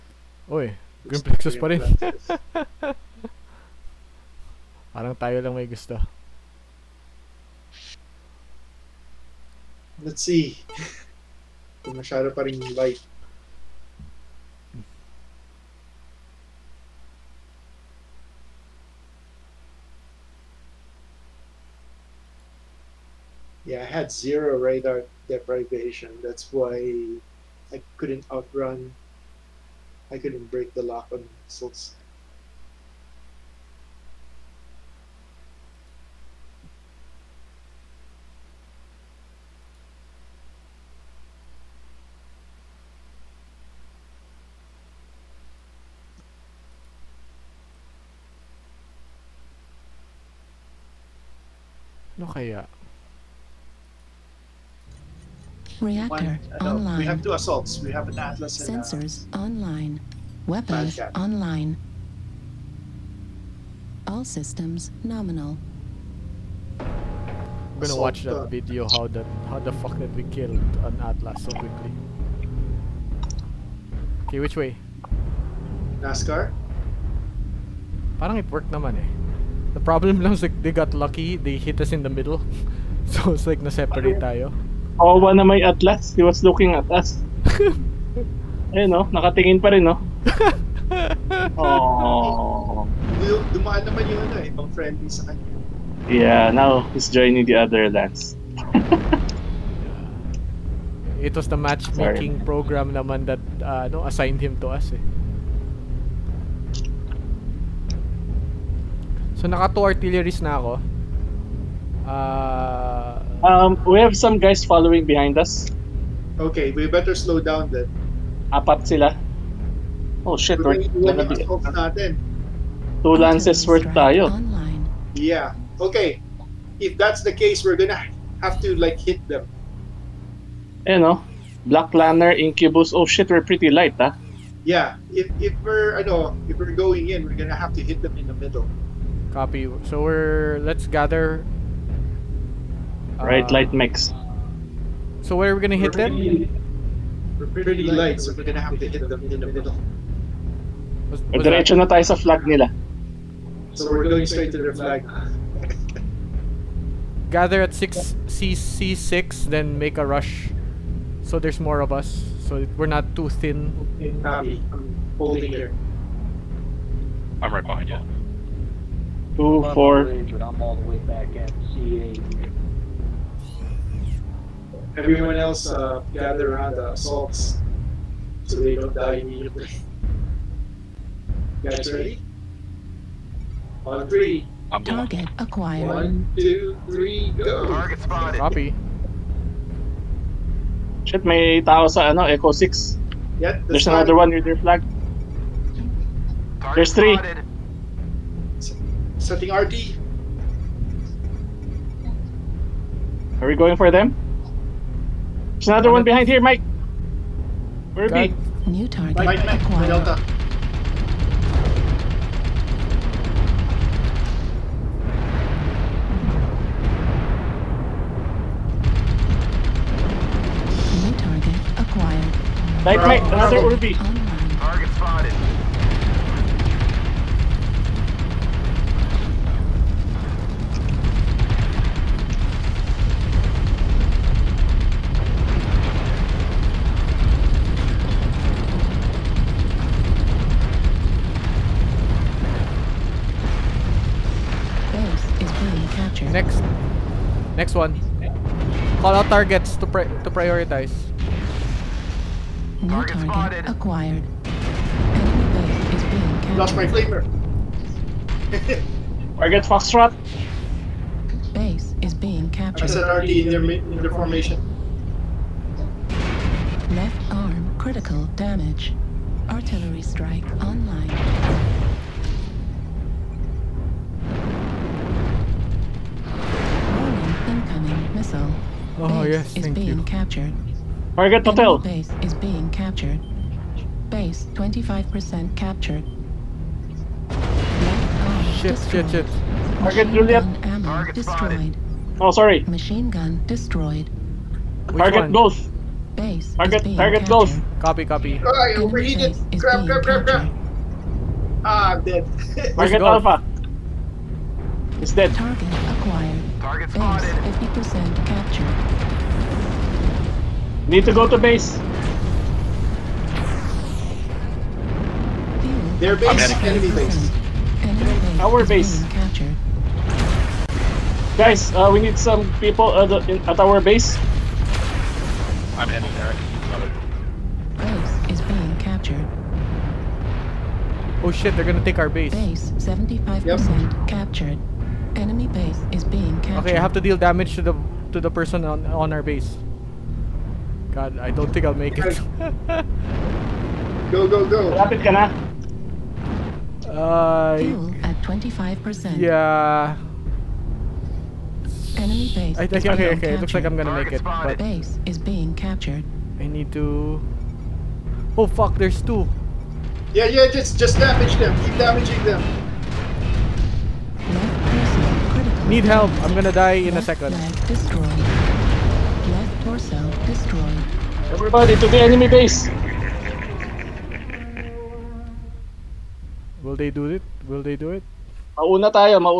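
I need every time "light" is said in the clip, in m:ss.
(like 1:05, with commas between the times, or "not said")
0:12, 2:13, 2:23, 2:27.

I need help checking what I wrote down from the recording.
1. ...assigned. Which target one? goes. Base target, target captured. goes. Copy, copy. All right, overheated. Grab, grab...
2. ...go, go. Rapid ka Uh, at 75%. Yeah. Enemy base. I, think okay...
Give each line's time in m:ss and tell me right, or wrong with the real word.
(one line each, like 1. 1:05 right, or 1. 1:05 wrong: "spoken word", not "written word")
1. 4:53 wrong: "destroyed", not "assigned"
2. 5:44 wrong: "25", not "75".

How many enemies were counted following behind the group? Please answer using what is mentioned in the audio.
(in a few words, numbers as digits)
4.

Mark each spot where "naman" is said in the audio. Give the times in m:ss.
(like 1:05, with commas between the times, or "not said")
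1:18, 1:33, 1:42.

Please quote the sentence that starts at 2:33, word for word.
So we're going straight to their flag.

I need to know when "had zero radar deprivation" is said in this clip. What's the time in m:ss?
0:24.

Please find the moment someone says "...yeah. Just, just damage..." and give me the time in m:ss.
6:00.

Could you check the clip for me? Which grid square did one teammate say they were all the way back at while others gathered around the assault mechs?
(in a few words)
C8.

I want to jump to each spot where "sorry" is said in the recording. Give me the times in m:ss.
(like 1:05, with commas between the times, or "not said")
1:42, 4:52.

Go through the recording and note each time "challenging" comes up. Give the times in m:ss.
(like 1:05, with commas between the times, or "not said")
not said.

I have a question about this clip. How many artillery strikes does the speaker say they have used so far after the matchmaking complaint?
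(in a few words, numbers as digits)
2.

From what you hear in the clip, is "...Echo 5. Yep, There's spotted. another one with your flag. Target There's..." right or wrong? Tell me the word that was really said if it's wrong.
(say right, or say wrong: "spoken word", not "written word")
wrong: "6", not "5".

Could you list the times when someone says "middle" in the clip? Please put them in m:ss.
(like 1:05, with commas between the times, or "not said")
1:22, 2:18, 2:29.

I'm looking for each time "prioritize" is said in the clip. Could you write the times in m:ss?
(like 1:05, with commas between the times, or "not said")
4:10.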